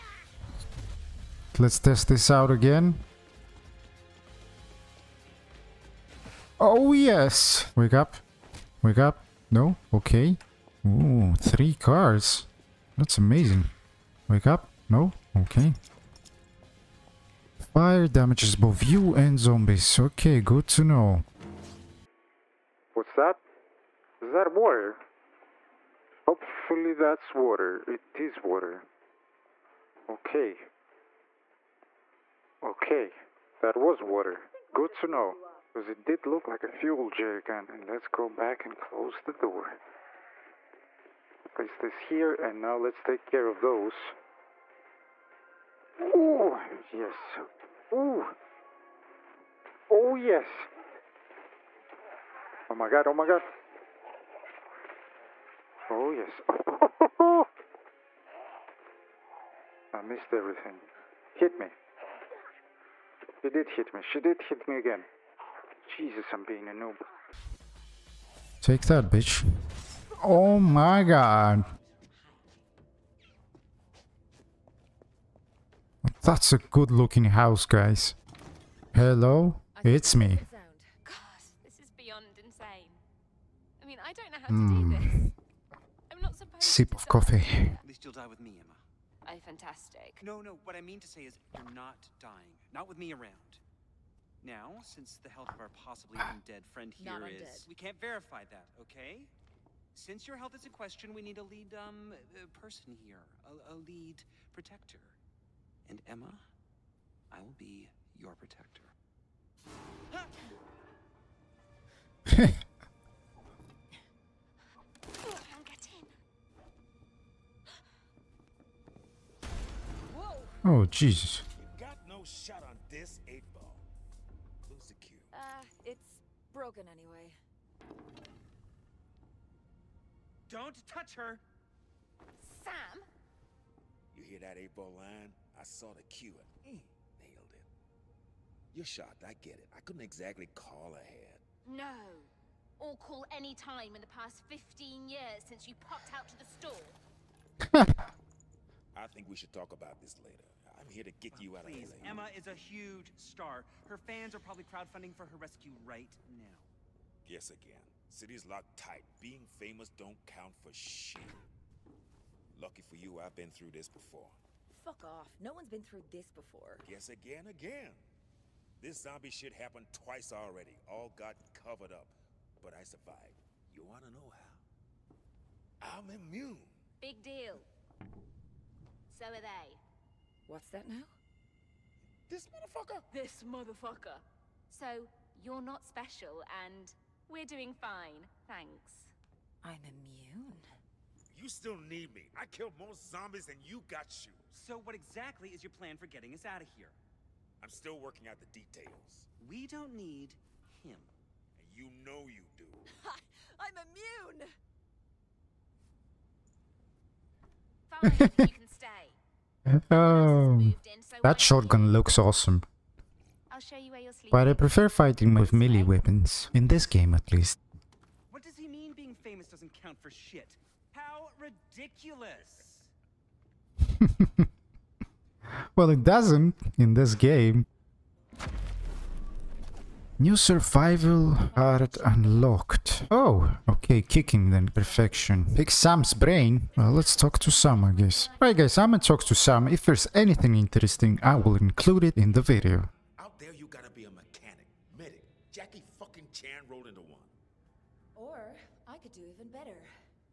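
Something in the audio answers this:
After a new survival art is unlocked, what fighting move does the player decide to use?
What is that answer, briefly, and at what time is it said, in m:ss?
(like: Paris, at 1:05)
kicking, at 3:54.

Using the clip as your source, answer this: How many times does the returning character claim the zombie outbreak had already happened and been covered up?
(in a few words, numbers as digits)
twice.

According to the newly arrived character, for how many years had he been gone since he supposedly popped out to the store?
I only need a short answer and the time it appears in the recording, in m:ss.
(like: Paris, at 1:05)
15, at 2:24.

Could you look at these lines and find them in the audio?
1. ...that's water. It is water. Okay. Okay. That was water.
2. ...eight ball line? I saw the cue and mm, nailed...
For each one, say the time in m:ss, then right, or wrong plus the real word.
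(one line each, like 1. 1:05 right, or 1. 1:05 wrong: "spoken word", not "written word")
1. 0:26 right
2. 2:14 right.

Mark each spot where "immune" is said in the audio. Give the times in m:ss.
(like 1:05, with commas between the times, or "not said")
2:56, 3:09, 3:28.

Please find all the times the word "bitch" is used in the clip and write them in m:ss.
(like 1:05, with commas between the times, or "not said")
1:09.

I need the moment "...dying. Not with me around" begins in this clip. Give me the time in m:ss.
1:32.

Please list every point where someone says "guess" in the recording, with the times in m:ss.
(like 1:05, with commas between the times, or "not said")
2:37, 2:46, 3:57.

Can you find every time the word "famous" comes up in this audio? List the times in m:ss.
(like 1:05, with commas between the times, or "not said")
2:39, 3:39.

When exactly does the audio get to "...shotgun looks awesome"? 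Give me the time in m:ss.
3:31.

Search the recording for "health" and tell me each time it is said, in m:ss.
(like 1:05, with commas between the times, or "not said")
1:35, 1:40.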